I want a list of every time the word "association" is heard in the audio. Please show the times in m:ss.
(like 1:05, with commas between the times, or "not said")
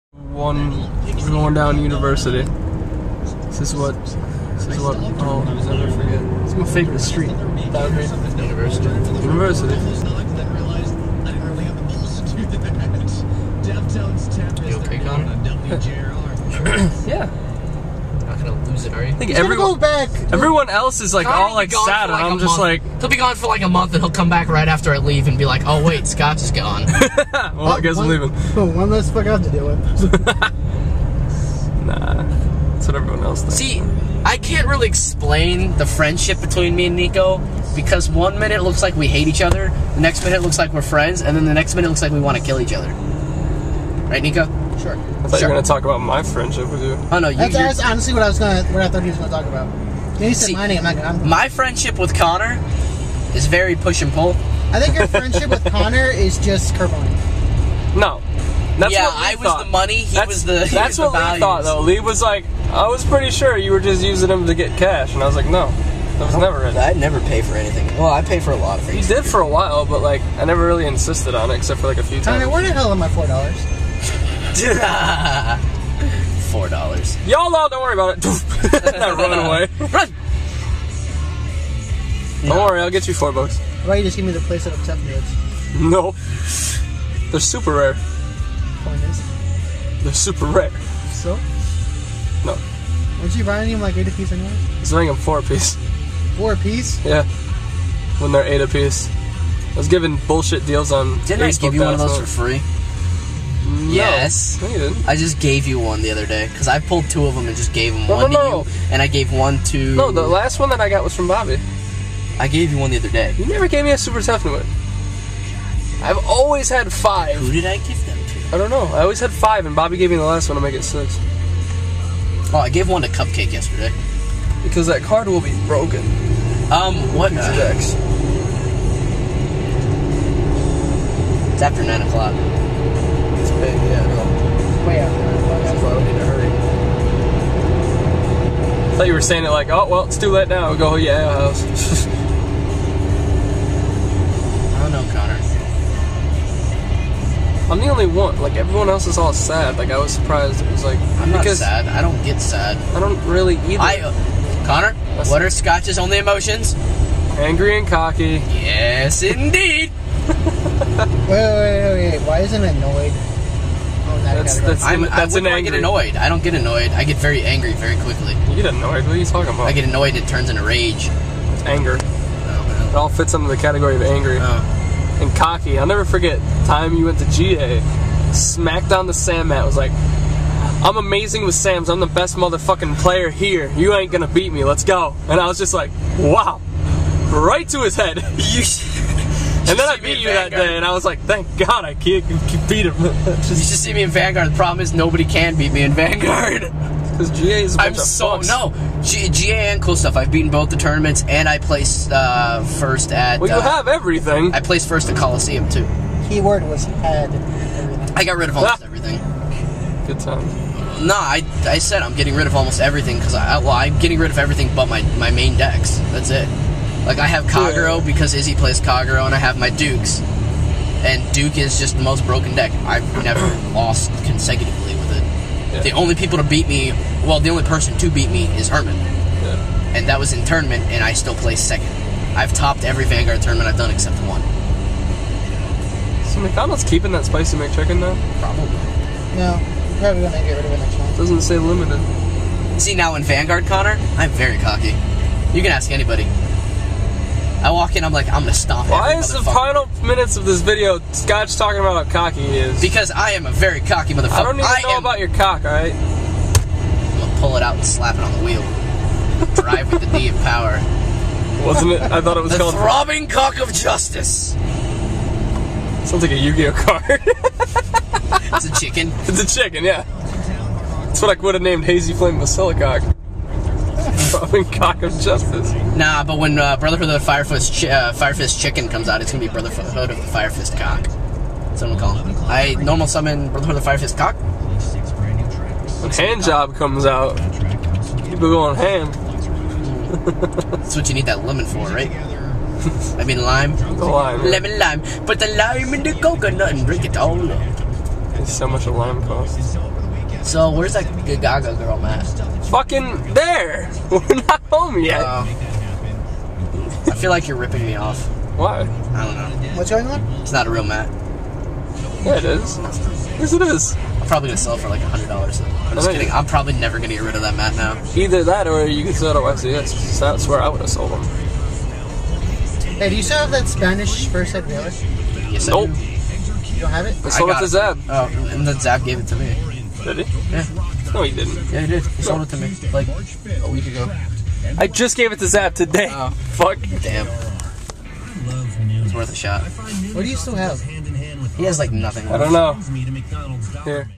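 not said.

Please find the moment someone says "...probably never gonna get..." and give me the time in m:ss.
5:16.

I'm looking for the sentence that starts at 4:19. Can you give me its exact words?
Drive with the D of power.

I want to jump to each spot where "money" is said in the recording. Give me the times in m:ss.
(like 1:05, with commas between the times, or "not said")
0:59.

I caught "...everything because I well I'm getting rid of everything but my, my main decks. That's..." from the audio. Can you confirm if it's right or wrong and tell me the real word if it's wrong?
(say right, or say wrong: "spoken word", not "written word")
right.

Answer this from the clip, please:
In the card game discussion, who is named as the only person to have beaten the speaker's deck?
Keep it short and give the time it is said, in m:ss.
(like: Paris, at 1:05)
Herman, at 3:48.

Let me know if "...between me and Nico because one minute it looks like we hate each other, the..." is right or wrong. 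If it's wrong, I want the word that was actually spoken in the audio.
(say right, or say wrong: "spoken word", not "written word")
right.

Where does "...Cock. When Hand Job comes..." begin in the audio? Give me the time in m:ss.
4:44.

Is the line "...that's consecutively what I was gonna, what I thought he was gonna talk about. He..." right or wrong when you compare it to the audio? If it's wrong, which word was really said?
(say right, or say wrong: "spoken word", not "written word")
wrong: "honestly", not "consecutively".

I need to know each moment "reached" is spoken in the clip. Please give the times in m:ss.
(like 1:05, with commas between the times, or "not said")
not said.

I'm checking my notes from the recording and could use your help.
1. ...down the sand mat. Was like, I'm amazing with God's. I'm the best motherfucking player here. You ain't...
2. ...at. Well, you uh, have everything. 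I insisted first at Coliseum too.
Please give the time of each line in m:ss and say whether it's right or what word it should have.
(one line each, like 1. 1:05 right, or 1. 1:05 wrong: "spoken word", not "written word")
1. 2:58 wrong: "Sam", not "God"
2. 3:23 wrong: "placed", not "insisted".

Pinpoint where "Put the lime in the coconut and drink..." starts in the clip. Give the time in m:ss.
4:55.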